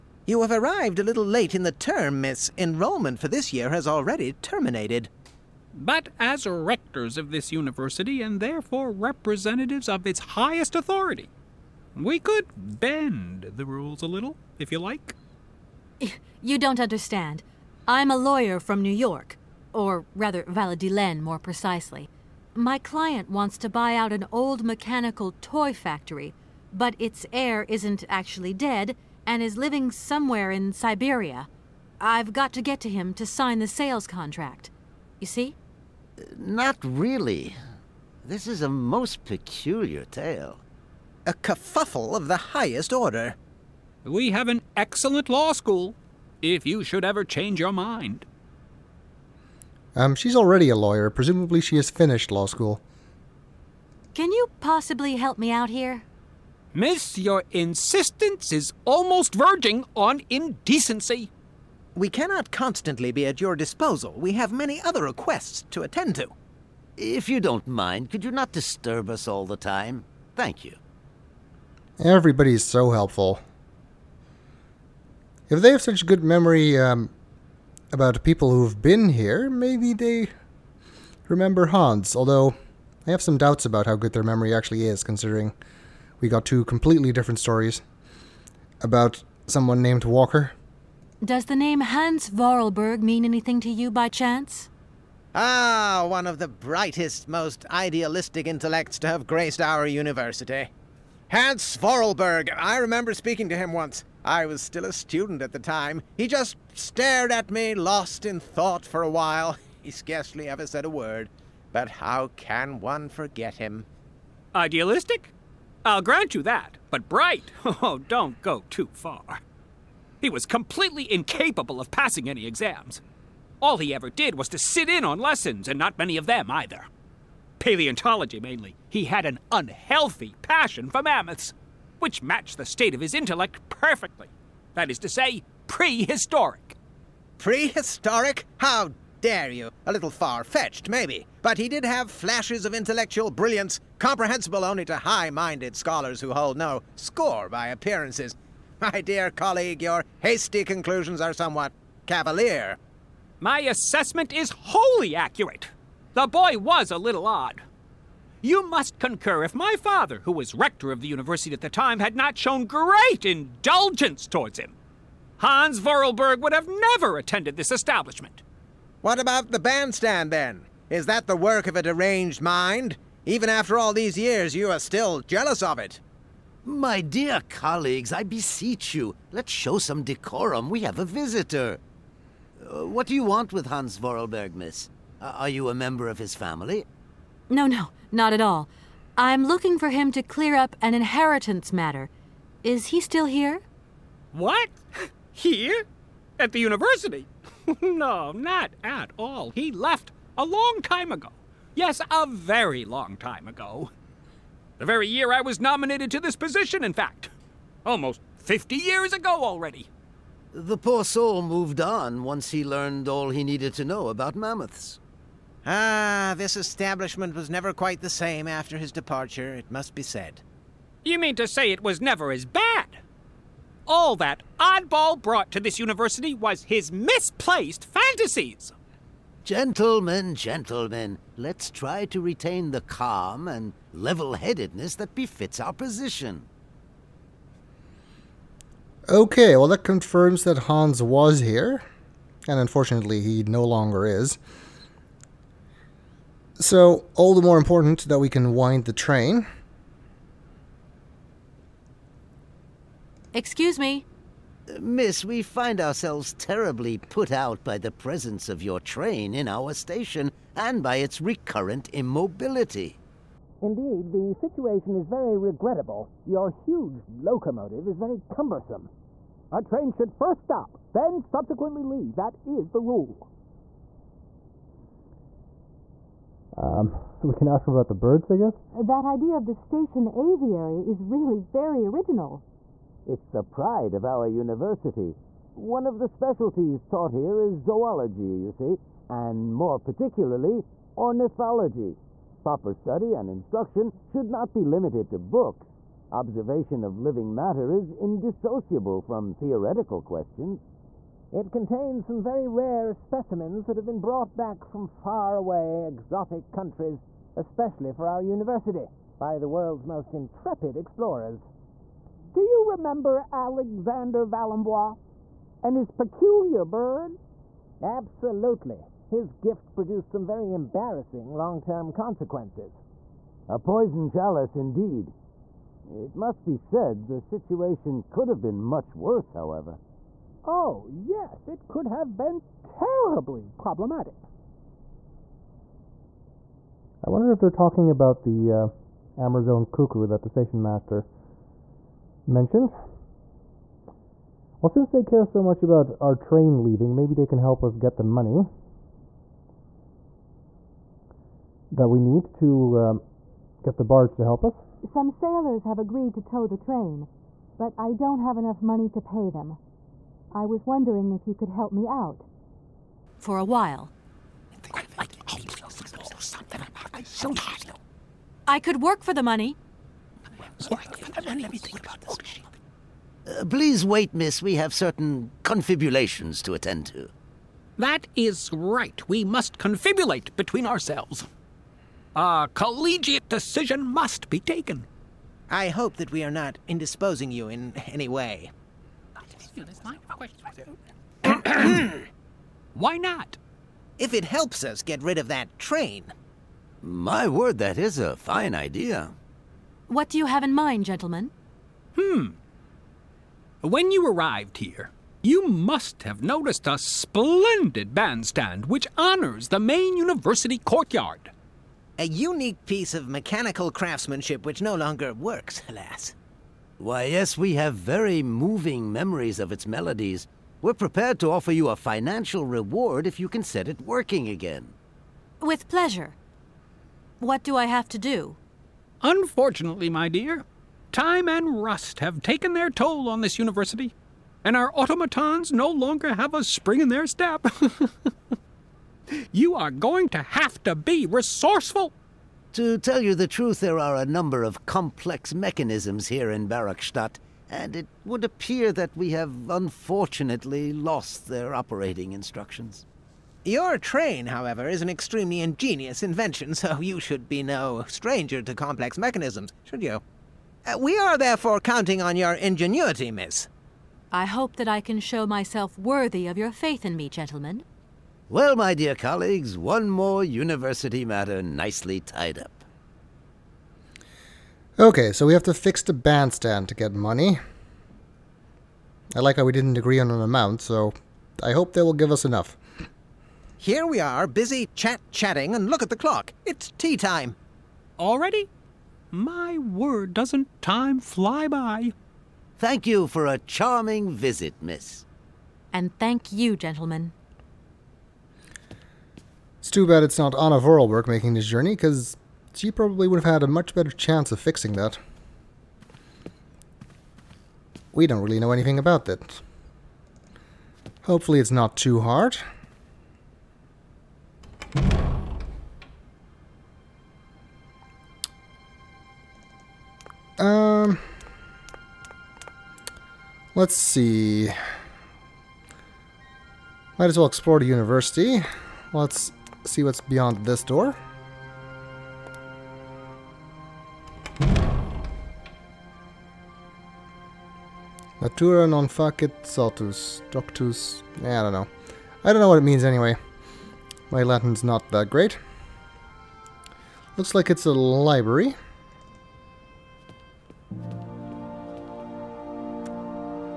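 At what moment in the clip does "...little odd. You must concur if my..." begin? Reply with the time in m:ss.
2:36.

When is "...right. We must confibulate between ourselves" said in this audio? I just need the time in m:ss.
6:18.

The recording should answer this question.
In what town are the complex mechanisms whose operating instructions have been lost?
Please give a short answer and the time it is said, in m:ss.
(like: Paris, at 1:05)
Barockstadt, at 7:26.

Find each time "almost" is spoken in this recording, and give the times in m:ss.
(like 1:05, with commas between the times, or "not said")
0:58, 3:27.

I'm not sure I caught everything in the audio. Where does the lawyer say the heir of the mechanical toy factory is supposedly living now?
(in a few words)
Siberia.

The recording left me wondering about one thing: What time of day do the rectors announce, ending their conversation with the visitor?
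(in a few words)
Tea time.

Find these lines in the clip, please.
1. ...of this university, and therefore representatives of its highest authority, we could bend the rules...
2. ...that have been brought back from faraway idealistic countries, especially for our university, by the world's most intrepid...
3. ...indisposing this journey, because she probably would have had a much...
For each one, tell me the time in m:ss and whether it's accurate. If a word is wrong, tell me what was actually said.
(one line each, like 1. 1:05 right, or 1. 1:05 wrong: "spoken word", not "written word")
1. 0:07 right
2. 5:03 wrong: "exotic", not "idealistic"
3. 8:21 wrong: "making", not "indisposing".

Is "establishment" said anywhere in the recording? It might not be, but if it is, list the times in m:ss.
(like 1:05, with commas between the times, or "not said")
2:47, 3:36.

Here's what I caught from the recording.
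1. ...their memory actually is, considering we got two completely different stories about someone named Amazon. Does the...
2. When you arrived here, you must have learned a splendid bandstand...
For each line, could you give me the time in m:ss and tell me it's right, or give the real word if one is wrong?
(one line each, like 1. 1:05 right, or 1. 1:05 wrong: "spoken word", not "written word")
1. 1:24 wrong: "Walker", not "Amazon"
2. 6:43 wrong: "noticed", not "learned".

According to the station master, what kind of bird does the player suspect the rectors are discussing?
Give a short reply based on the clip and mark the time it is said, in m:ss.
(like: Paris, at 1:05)
Amazon cuckoo, at 5:39.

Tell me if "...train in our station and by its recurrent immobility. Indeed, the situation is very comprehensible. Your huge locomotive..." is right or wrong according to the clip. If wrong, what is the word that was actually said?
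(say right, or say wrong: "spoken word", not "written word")
wrong: "regrettable", not "comprehensible".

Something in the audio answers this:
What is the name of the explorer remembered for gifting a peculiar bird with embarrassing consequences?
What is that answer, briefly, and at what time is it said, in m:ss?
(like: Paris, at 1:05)
Alexander Valembois, at 5:13.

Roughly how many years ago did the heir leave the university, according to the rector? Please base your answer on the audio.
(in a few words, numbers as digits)
50.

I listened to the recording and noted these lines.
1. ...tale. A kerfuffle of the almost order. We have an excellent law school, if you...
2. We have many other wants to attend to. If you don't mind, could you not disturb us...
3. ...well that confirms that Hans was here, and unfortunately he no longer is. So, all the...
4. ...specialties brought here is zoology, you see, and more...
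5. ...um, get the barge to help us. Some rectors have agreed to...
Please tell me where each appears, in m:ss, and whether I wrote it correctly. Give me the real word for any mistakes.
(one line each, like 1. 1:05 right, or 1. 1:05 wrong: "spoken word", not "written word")
1. 0:40 wrong: "highest", not "almost"
2. 1:04 wrong: "requests", not "wants"
3. 3:59 right
4. 4:46 wrong: "taught", not "brought"
5. 5:52 wrong: "sailors", not "rectors".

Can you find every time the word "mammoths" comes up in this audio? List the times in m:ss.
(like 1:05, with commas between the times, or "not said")
2:11, 3:34.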